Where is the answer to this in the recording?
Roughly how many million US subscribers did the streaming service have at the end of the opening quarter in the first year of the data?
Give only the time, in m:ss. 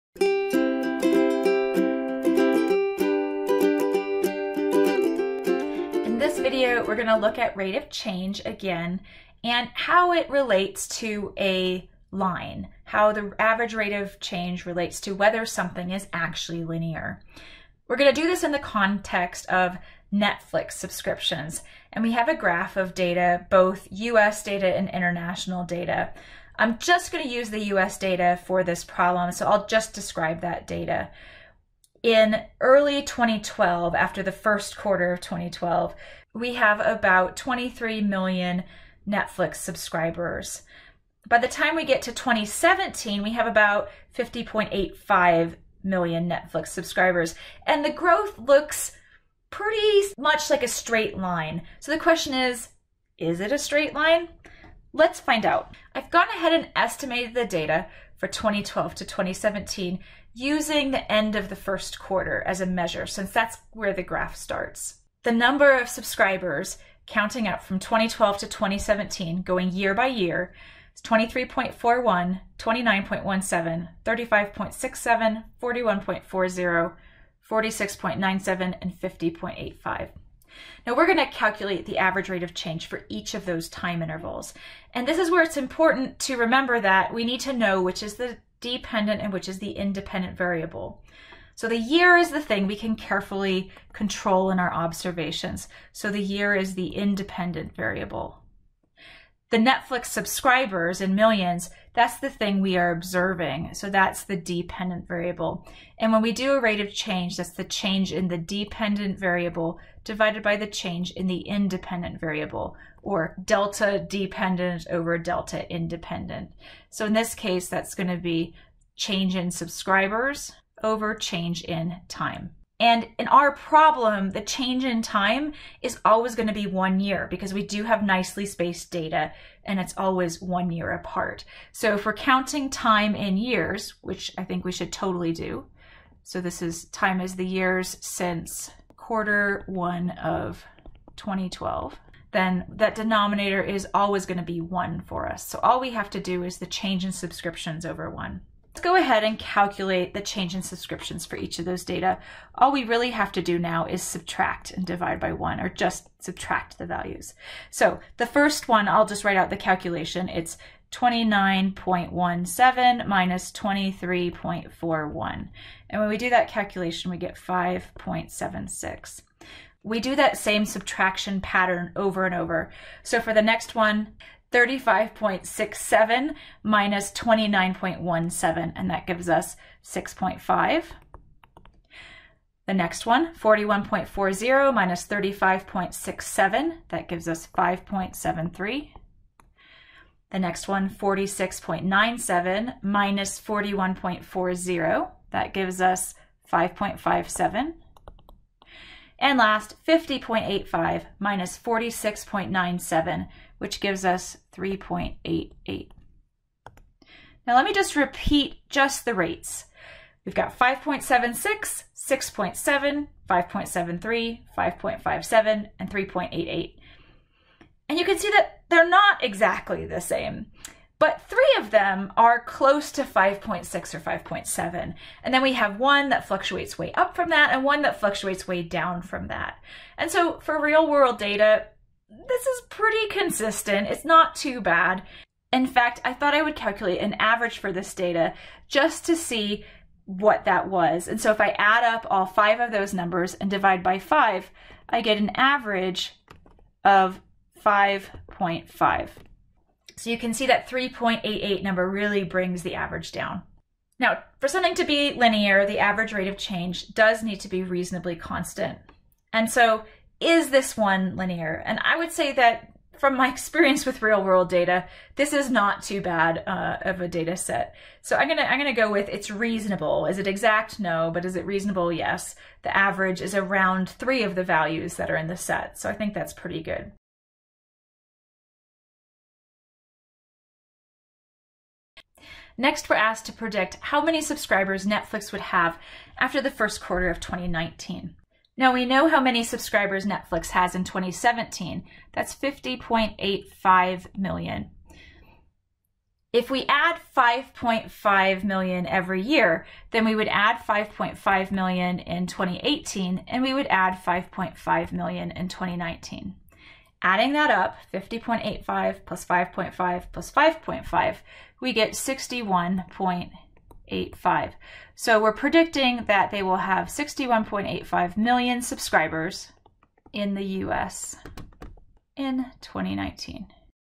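0:36.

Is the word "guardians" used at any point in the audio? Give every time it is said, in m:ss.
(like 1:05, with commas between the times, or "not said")
not said.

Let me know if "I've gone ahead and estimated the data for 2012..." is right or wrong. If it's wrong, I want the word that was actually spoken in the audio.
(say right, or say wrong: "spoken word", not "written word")
right.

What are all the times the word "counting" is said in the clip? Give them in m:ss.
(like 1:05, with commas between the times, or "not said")
1:07, 2:12.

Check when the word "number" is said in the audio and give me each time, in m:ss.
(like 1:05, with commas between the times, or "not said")
1:05, 4:02, 4:11.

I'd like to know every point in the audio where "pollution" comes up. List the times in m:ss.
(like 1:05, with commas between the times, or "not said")
not said.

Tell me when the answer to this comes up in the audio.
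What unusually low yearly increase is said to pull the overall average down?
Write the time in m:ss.
4:10.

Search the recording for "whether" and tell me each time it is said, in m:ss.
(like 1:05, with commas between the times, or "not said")
0:15.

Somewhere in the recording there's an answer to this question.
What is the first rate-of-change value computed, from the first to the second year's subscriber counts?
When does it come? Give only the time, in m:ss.
2:47.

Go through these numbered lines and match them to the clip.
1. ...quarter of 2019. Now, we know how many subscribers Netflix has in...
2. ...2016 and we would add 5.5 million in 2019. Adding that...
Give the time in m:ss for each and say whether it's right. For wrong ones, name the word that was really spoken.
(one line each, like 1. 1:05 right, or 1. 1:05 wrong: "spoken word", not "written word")
1. 4:46 right
2. 5:02 wrong: "2018", not "2016".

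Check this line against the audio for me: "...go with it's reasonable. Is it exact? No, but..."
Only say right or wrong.
right.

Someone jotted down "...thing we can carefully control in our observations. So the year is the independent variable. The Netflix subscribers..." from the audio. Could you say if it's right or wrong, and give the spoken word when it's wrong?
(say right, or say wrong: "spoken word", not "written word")
right.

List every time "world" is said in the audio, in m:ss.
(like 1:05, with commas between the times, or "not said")
3:50, 4:24.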